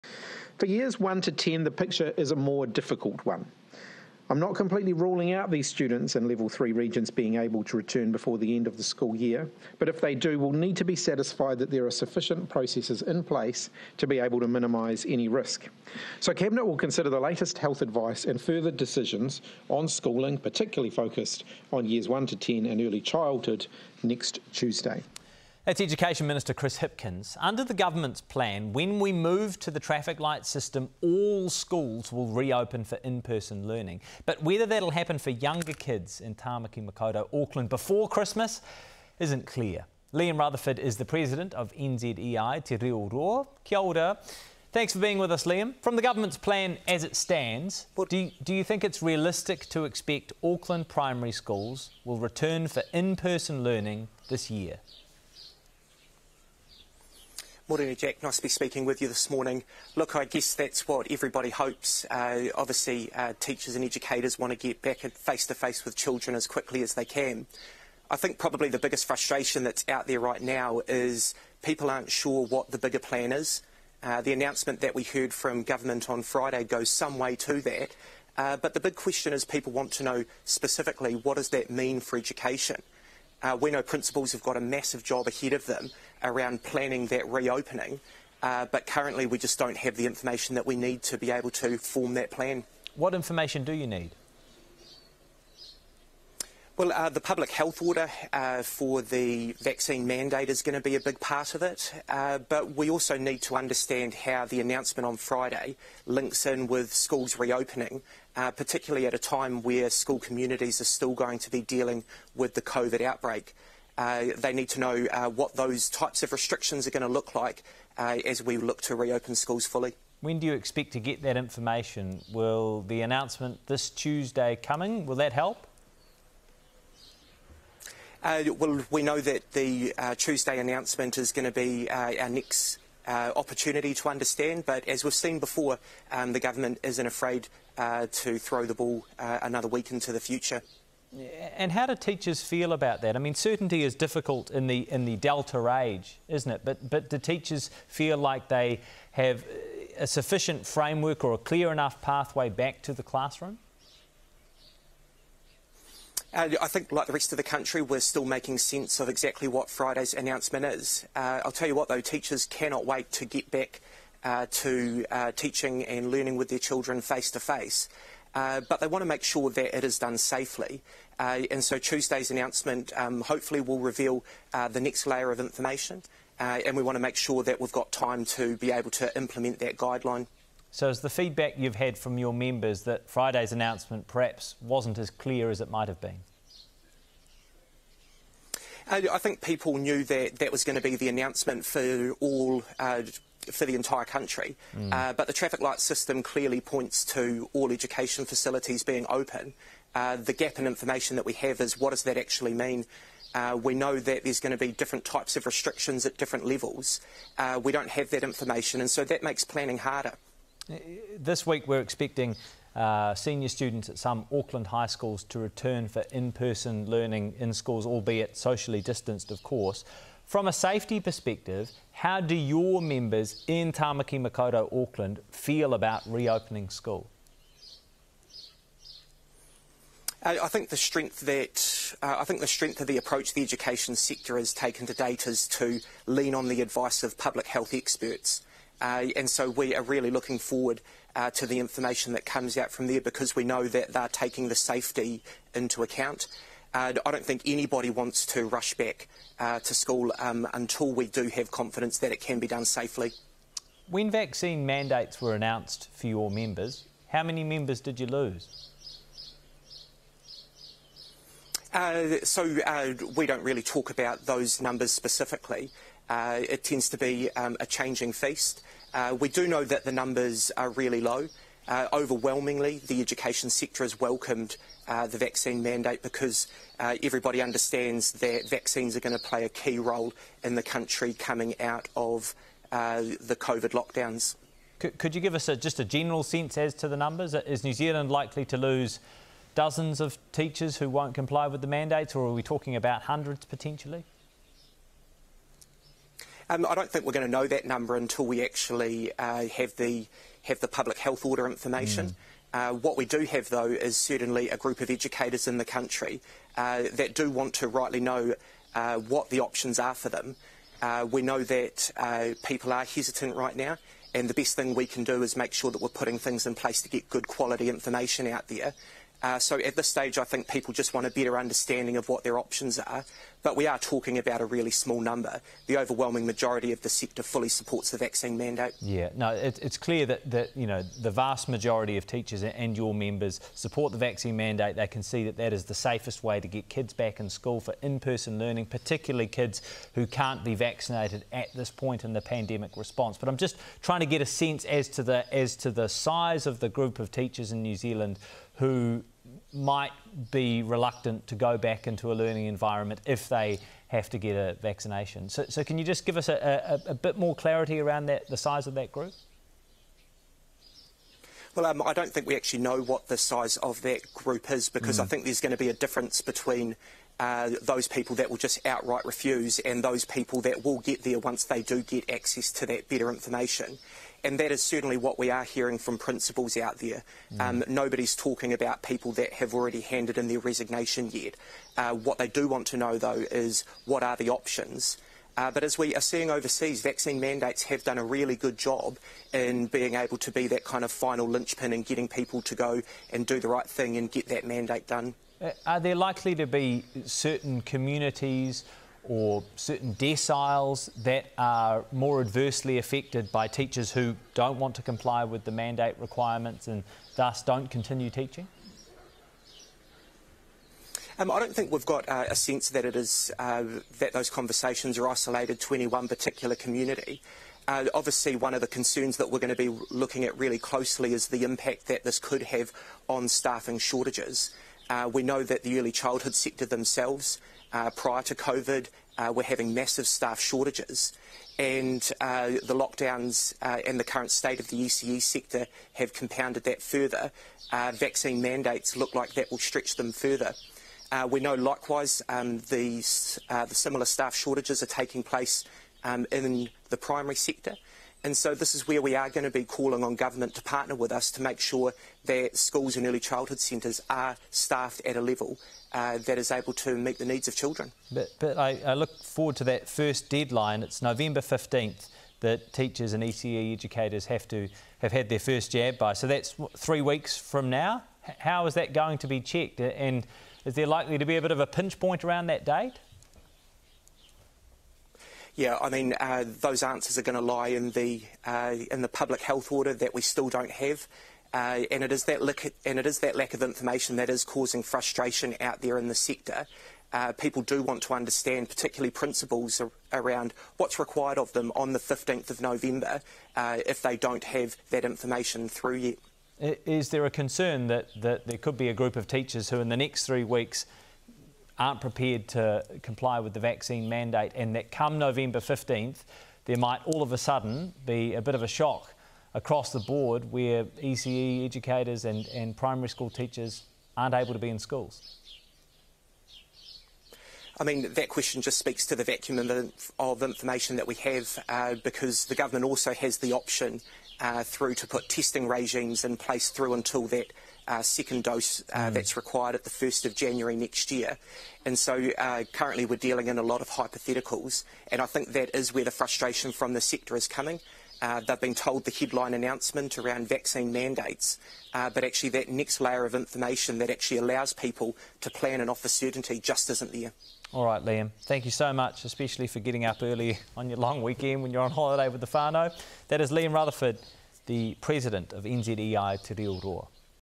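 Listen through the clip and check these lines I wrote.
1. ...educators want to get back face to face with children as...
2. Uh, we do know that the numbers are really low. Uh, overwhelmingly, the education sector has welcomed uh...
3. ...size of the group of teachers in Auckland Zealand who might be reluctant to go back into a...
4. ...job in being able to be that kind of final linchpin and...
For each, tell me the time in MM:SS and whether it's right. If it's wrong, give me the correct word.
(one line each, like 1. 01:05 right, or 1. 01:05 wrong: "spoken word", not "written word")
1. 01:03 right
2. 04:28 right
3. 05:45 wrong: "New", not "Auckland"
4. 06:28 right.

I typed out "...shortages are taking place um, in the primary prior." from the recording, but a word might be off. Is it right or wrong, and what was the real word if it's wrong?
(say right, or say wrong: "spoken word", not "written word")
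wrong: "sector", not "prior".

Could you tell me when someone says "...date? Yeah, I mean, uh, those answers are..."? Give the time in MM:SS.
07:52.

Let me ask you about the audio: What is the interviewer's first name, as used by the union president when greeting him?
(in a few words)
Jack.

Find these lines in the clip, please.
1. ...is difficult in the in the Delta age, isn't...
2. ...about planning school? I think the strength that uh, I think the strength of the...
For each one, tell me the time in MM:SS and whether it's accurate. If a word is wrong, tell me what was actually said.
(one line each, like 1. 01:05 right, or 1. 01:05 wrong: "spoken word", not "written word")
1. 02:23 right
2. 03:45 wrong: "reopening", not "planning".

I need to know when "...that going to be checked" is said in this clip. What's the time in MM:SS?
07:48.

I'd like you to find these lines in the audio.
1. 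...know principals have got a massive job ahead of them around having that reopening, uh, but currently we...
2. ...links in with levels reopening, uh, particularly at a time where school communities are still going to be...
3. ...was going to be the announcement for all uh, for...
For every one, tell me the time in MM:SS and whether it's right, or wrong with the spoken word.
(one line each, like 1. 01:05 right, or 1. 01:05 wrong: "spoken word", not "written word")
1. 01:23 wrong: "planning", not "having"
2. 01:46 wrong: "schools", not "levels"
3. 03:10 right.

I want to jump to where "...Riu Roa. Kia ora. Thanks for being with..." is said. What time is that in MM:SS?
00:42.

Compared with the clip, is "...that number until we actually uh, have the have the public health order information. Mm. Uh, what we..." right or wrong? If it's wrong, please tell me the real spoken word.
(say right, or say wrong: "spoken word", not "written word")
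right.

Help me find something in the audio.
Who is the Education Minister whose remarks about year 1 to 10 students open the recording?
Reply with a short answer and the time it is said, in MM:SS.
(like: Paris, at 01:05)
Chris Hipkins, at 00:26.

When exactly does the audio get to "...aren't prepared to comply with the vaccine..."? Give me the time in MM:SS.
08:21.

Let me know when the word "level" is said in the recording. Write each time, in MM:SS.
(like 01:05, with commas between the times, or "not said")
00:06, 03:26, 07:35.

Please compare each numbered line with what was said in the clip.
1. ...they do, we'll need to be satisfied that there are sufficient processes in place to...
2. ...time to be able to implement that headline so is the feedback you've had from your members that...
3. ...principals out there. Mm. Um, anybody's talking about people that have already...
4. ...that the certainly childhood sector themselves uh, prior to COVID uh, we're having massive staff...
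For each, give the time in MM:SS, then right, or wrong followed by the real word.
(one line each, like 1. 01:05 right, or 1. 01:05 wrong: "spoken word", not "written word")
1. 00:09 right
2. 02:57 wrong: "guideline", not "headline"
3. 06:15 wrong: "nobody", not "anybody"
4. 07:05 wrong: "early", not "certainly".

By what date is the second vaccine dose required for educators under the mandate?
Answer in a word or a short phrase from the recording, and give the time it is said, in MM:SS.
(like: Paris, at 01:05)
1st of January, at 08:49.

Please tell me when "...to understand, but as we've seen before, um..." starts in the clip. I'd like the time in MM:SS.
02:13.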